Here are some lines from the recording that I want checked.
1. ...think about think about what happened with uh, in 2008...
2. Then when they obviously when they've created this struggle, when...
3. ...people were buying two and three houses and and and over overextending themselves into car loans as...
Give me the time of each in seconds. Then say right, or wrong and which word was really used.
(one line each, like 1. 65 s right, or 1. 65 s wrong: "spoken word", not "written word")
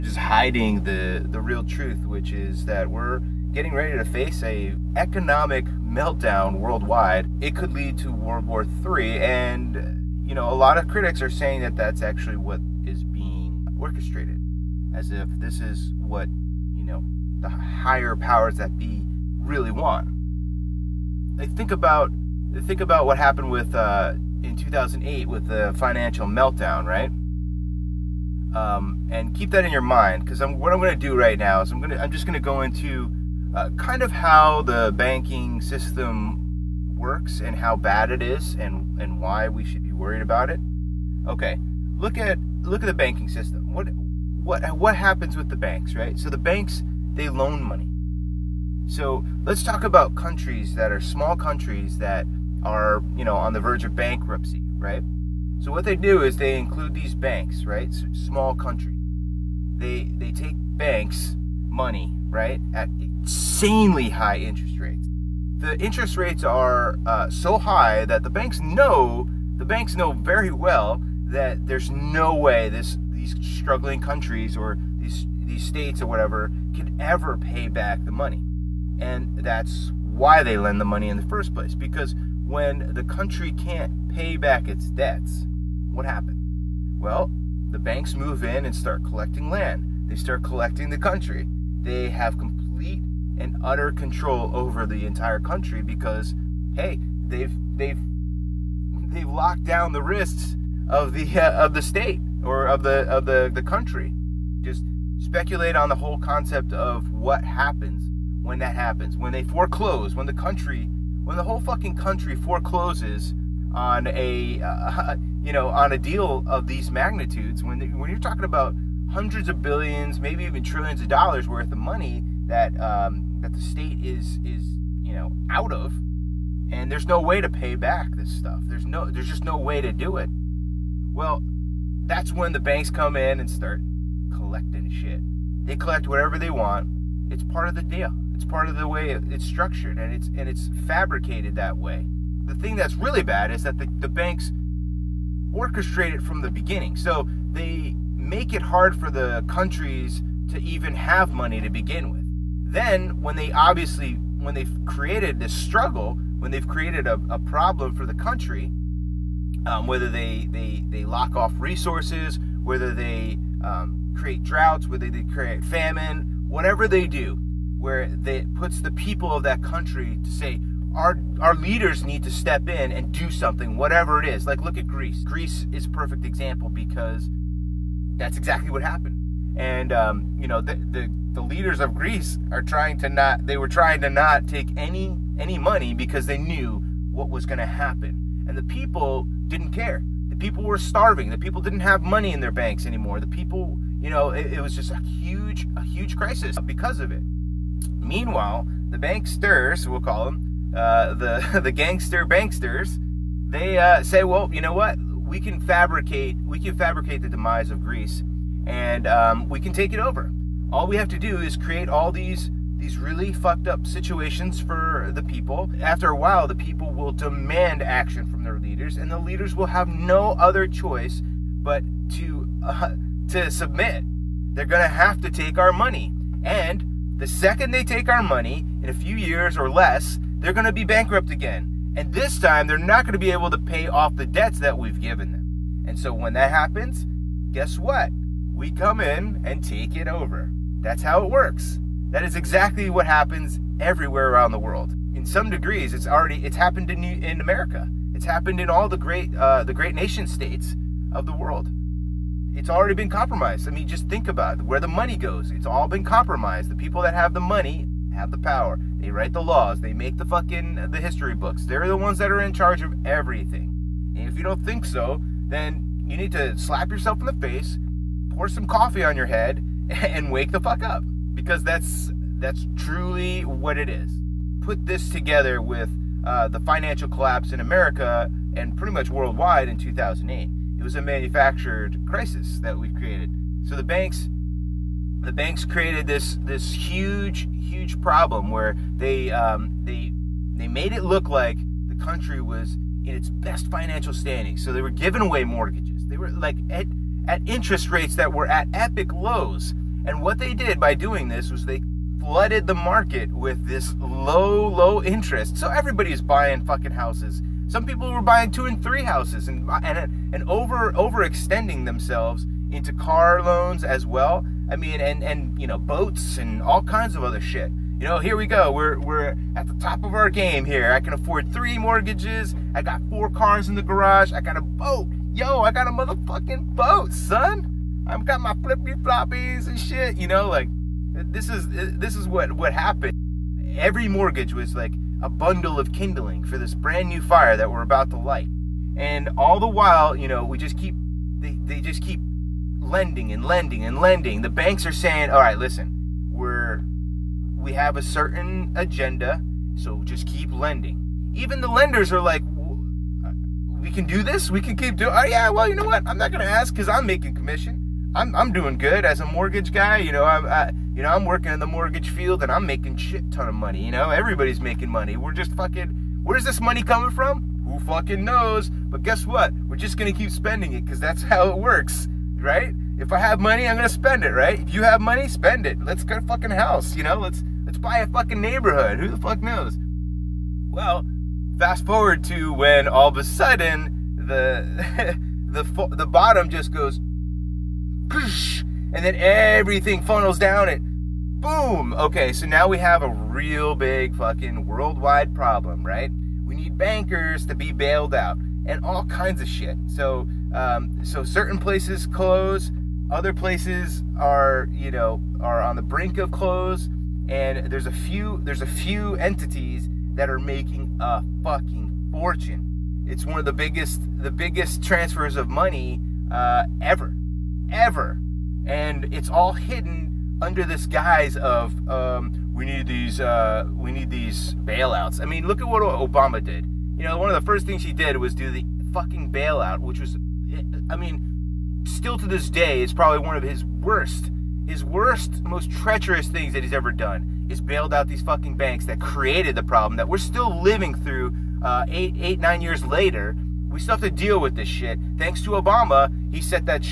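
1. 21 s right
2. 152 s right
3. 307 s right.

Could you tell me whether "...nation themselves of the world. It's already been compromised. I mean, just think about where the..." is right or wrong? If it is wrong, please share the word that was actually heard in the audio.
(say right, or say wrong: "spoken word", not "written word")
wrong: "states", not "themselves".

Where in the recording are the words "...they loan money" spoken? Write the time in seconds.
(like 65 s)
47 s.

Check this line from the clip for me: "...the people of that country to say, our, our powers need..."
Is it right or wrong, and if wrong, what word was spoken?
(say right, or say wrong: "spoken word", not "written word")
wrong: "leaders", not "powers".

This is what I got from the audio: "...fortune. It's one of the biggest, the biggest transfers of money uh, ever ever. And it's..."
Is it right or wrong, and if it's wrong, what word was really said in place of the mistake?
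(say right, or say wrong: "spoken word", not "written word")
right.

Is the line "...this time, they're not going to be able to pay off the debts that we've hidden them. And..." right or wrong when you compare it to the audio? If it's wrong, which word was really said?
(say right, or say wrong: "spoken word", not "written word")
wrong: "given", not "hidden".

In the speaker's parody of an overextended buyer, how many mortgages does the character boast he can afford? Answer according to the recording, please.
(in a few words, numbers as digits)
3.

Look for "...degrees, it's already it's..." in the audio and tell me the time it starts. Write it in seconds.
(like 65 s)
245 s.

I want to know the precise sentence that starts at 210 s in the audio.
All we have to do is create all these these really fucked up situations for the people.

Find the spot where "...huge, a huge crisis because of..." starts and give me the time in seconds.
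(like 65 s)
195 s.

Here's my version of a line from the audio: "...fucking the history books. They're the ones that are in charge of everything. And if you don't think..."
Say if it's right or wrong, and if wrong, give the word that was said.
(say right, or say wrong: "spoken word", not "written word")
right.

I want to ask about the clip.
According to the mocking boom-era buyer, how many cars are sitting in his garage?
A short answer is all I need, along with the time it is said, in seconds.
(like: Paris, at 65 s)
4, at 323 s.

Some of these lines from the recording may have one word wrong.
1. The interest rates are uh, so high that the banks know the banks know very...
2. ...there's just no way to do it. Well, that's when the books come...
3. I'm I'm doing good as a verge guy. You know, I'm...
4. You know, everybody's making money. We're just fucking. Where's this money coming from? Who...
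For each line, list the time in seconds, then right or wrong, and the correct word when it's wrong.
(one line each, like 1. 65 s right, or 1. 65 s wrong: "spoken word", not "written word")
1. 65 s right
2. 129 s wrong: "banks", not "books"
3. 358 s wrong: "mortgage", not "verge"
4. 363 s right.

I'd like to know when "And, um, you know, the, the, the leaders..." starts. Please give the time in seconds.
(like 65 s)
179 s.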